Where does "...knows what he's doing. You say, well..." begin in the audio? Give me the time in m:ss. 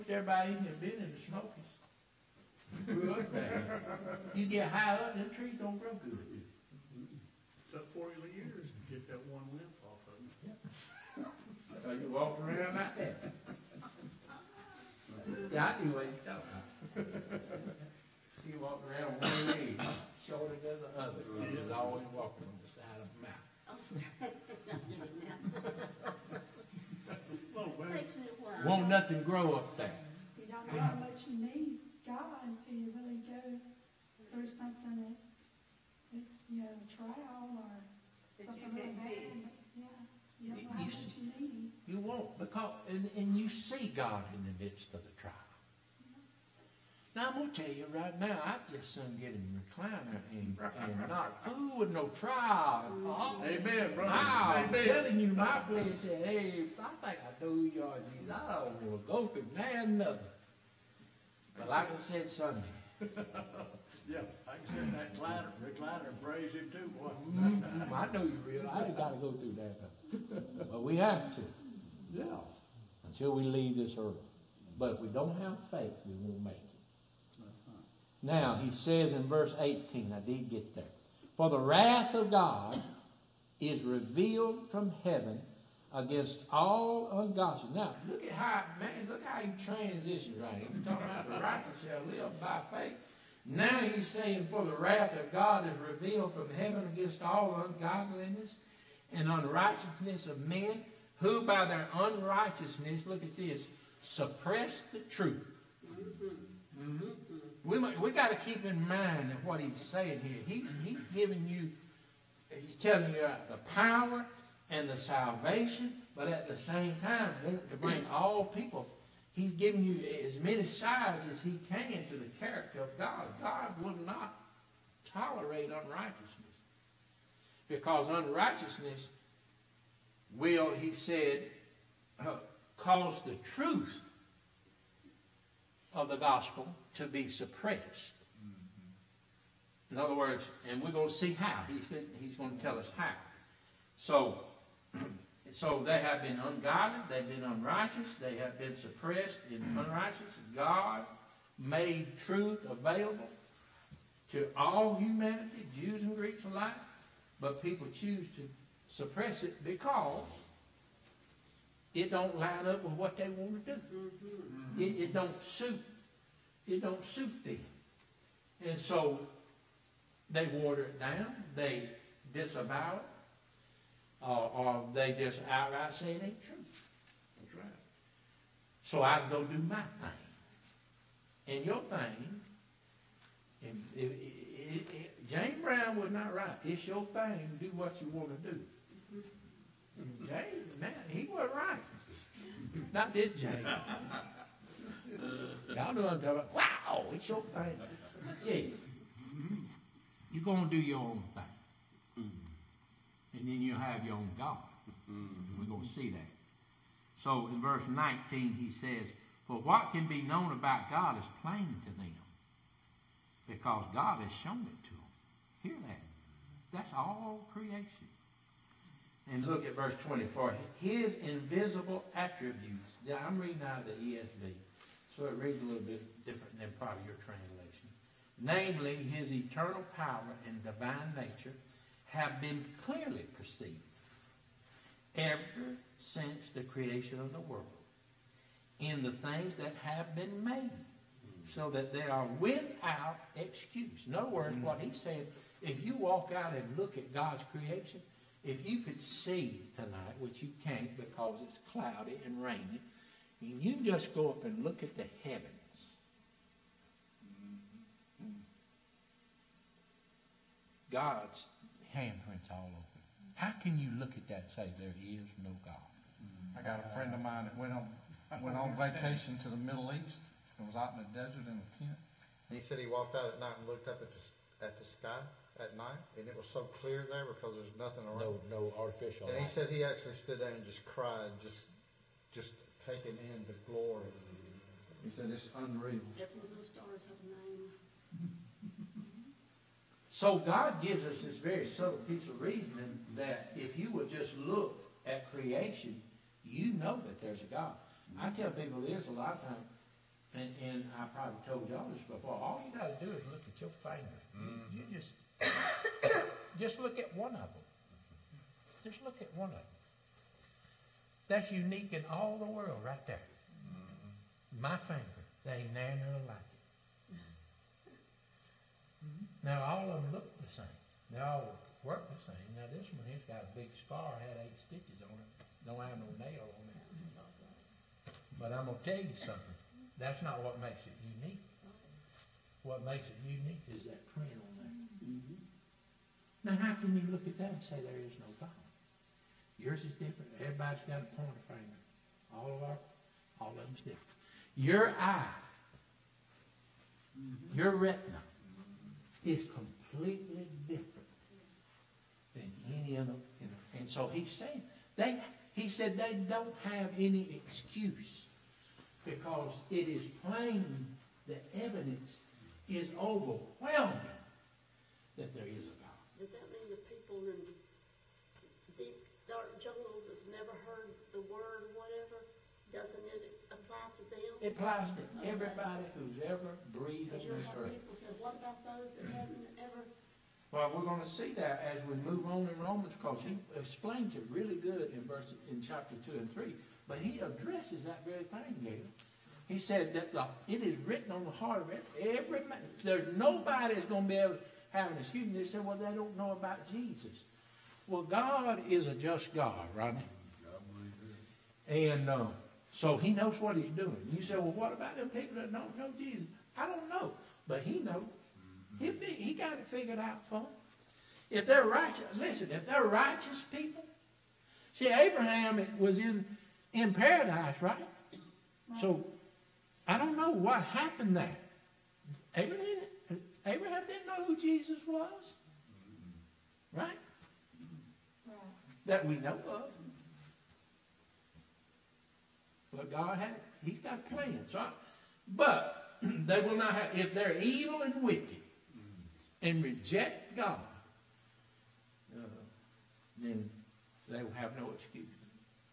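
6:43.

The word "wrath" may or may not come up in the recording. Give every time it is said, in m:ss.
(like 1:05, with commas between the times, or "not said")
1:21, 1:34.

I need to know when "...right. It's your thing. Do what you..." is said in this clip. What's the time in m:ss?
3:06.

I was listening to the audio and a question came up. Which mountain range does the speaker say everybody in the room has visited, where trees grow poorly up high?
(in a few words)
the Smokies.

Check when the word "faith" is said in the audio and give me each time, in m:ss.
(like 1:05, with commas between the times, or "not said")
1:15, 1:32.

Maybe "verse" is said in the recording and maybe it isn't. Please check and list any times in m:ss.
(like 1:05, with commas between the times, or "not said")
1:19, 3:27, 3:39, 6:25.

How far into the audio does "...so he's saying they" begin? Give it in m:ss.
5:53.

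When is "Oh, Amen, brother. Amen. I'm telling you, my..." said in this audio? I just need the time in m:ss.
0:53.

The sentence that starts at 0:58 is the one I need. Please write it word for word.
I don't want to go through man another.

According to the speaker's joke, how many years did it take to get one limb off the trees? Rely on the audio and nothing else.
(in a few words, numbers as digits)
40.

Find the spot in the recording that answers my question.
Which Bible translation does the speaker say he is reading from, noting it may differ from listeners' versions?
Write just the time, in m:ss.
3:43.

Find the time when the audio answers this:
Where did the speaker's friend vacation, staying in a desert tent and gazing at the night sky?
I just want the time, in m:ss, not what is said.
4:29.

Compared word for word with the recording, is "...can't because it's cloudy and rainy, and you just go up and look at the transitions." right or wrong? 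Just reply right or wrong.
wrong.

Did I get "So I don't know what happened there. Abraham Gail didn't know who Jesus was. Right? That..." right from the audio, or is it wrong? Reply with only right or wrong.
wrong.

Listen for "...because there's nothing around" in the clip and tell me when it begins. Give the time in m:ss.
4:37.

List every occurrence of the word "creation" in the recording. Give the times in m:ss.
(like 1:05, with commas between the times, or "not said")
3:37, 3:56, 4:07, 4:55.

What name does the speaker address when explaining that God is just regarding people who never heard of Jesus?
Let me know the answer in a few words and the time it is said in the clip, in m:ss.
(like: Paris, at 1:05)
Rodney, at 6:39.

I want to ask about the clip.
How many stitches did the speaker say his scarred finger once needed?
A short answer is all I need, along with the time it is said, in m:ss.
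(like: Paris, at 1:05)
8, at 5:24.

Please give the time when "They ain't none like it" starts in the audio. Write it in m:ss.
5:15.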